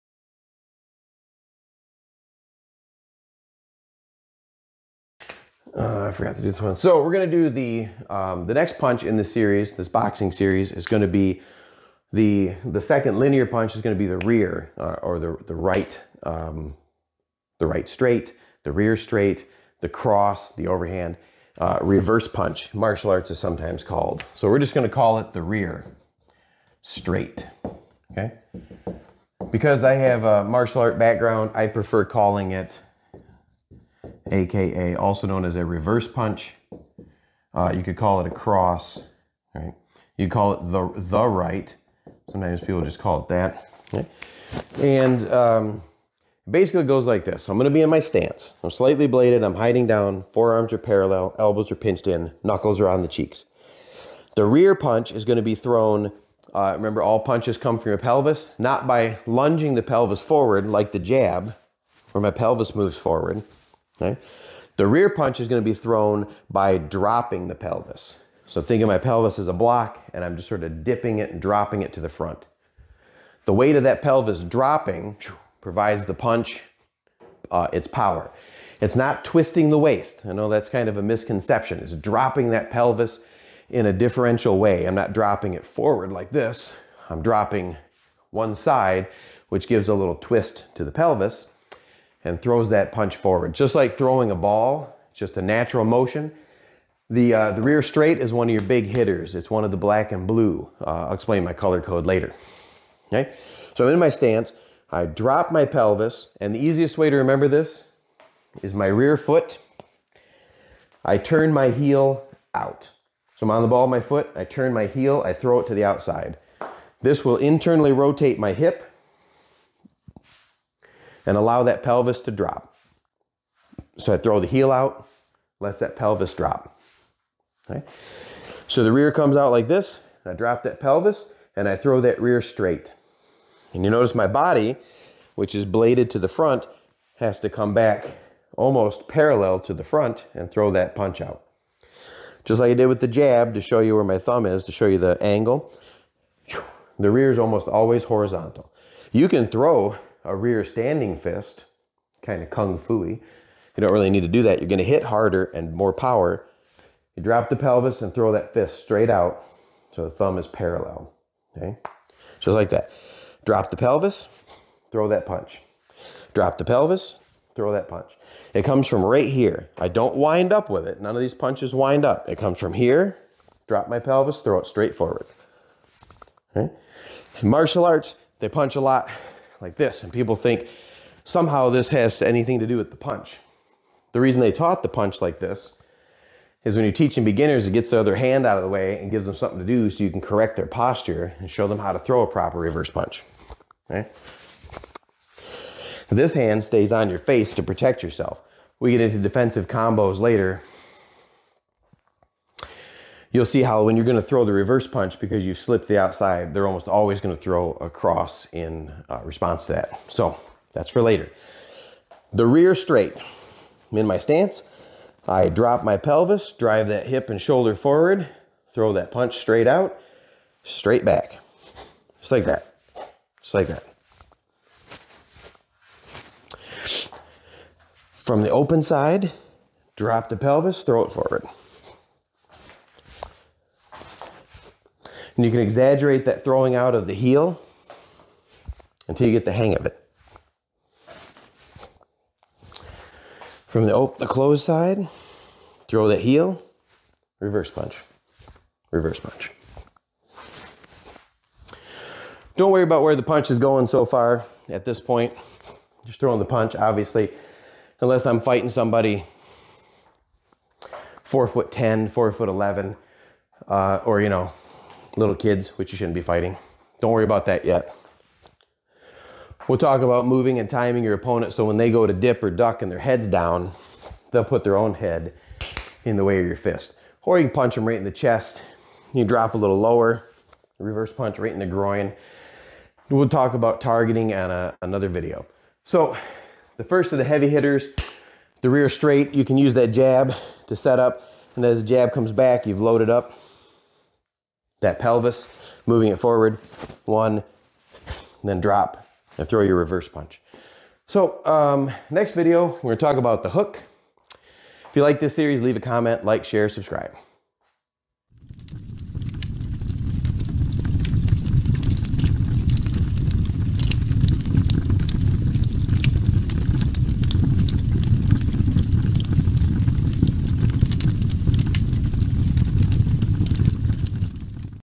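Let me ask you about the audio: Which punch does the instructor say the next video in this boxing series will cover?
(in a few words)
the hook.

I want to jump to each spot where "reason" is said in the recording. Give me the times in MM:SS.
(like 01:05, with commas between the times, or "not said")
03:04.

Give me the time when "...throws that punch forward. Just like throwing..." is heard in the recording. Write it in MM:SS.
01:32.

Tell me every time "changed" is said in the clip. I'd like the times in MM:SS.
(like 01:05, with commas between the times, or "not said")
not said.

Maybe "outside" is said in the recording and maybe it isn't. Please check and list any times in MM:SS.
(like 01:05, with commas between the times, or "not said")
01:55, 03:25.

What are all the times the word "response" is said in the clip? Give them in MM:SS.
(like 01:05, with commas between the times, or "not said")
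03:29.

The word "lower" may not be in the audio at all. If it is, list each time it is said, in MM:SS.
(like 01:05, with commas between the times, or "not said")
04:39.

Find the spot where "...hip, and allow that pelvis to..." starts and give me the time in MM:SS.
01:58.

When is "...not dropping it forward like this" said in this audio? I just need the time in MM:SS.
01:24.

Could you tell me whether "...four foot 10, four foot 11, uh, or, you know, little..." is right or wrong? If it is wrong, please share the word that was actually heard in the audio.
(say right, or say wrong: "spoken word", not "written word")
right.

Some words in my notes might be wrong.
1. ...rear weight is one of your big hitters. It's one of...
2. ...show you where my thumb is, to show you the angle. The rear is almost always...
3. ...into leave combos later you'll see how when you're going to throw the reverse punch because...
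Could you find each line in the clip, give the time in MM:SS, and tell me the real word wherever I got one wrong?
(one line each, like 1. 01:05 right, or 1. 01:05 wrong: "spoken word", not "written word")
1. 01:37 wrong: "straight", not "weight"
2. 02:23 right
3. 03:19 wrong: "defensive", not "leave".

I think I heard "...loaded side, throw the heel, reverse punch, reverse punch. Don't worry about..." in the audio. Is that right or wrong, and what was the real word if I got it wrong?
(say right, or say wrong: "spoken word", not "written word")
wrong: "closed", not "loaded".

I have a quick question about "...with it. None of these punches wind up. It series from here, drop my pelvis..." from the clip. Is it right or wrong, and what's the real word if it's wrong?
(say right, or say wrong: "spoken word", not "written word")
wrong: "comes", not "series".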